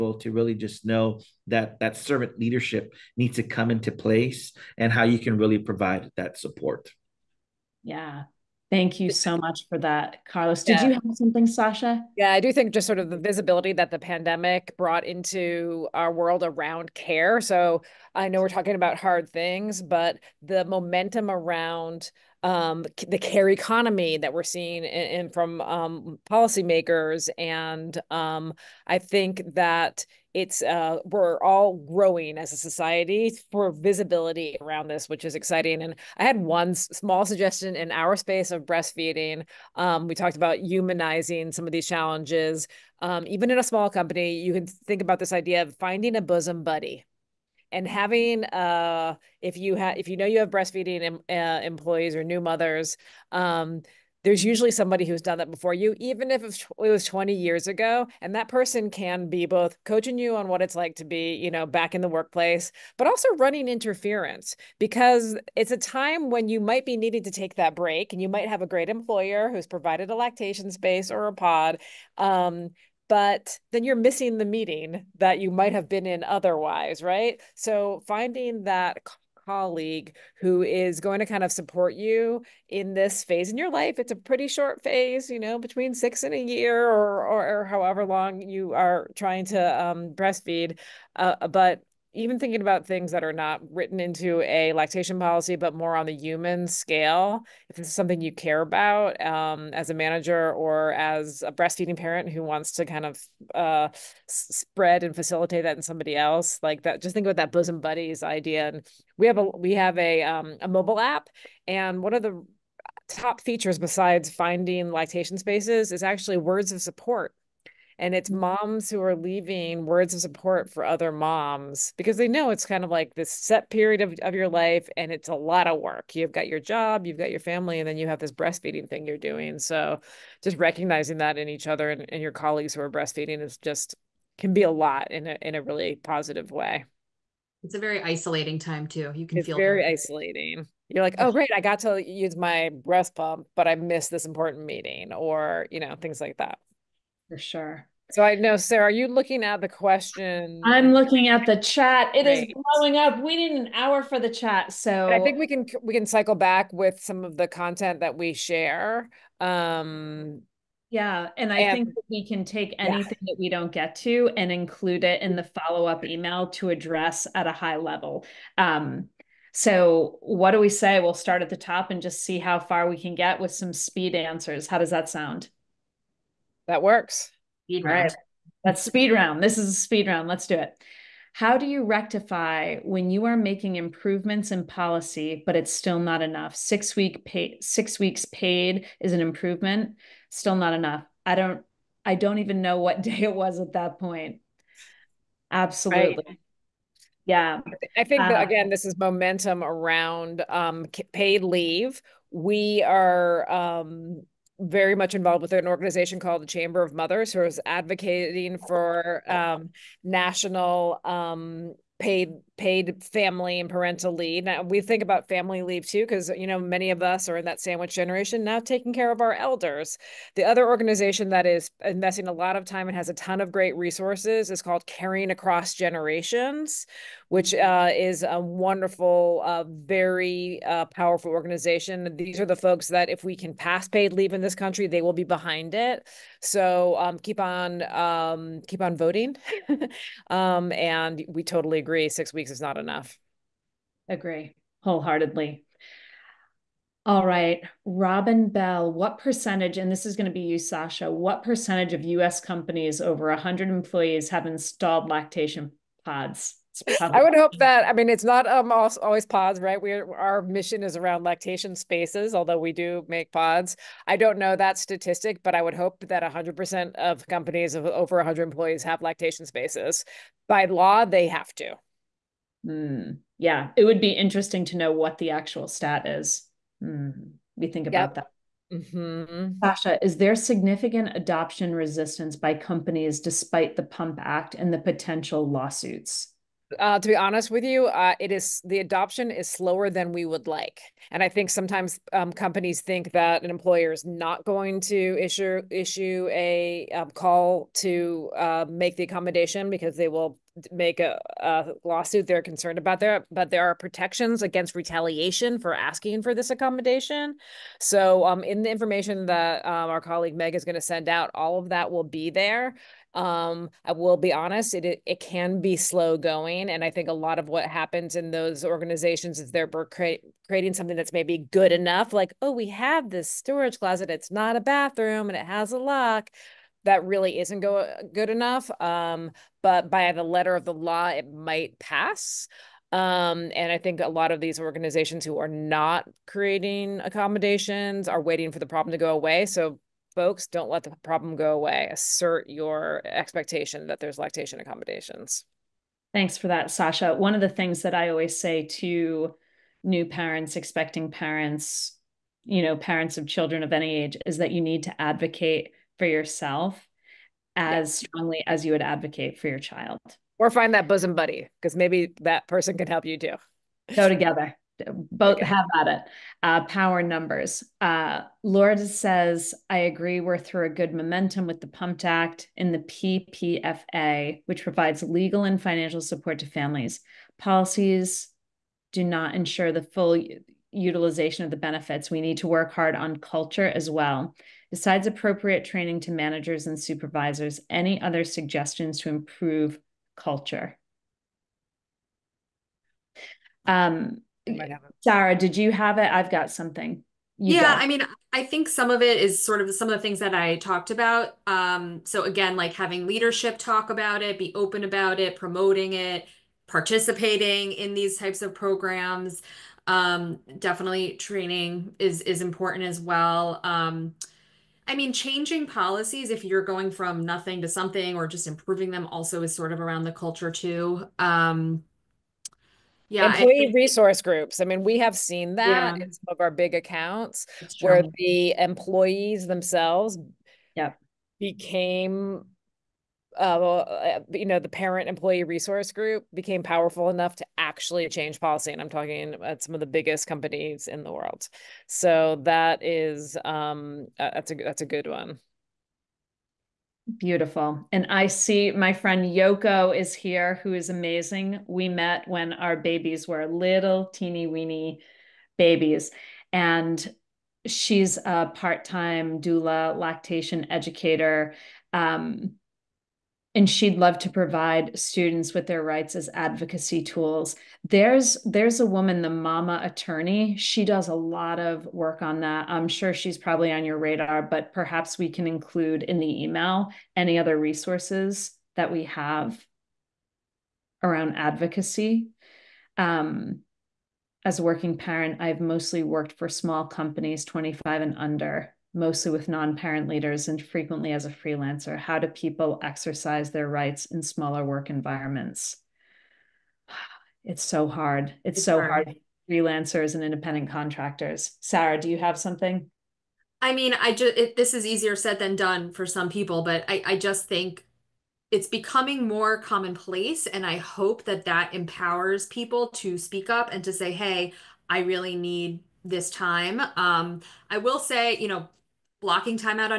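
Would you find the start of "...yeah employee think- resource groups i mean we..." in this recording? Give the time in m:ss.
7:03.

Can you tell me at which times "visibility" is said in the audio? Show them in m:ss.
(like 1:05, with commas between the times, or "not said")
0:13, 0:33.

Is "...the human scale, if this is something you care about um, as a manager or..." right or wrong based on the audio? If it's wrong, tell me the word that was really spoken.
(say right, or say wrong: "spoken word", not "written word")
right.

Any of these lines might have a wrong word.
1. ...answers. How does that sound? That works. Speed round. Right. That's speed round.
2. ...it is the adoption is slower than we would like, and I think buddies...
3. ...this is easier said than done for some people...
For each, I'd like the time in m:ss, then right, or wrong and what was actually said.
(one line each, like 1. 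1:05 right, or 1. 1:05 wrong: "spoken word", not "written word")
1. 2:54 right
2. 4:48 wrong: "sometimes", not "buddies"
3. 8:24 right.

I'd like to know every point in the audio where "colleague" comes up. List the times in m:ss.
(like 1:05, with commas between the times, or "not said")
1:19, 2:12, 5:09.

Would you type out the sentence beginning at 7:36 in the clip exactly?
And she's a part time doula lactation educator.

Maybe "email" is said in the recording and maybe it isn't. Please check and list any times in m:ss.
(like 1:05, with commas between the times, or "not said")
2:46, 7:56.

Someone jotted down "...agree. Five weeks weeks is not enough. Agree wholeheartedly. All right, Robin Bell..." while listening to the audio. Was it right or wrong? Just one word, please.
wrong.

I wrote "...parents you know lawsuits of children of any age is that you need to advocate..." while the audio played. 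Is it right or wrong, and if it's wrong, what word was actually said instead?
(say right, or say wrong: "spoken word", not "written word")
wrong: "parents", not "lawsuits".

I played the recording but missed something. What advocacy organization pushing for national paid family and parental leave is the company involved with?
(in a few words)
Chamber of Mothers.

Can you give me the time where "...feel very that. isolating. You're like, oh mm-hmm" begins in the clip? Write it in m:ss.
2:19.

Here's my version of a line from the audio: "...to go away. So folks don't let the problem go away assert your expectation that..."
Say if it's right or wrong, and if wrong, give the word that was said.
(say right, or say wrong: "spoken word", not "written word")
right.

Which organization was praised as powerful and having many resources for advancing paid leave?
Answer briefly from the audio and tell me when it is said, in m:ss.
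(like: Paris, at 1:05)
Caring Across Generations, at 3:44.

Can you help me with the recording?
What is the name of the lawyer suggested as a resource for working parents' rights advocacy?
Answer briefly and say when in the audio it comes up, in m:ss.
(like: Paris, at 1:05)
the Mama Attorney, at 7:49.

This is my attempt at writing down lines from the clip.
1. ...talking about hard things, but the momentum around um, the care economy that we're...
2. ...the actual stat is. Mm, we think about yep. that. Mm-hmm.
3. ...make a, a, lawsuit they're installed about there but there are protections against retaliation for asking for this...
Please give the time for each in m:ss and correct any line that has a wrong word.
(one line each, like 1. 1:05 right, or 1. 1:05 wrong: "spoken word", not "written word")
1. 0:18 right
2. 4:35 right
3. 5:00 wrong: "concerned", not "installed".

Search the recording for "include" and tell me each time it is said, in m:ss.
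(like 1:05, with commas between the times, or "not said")
2:44, 7:55.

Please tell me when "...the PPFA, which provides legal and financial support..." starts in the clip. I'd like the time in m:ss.
6:12.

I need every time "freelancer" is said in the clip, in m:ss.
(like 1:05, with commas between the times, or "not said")
8:11, 8:19.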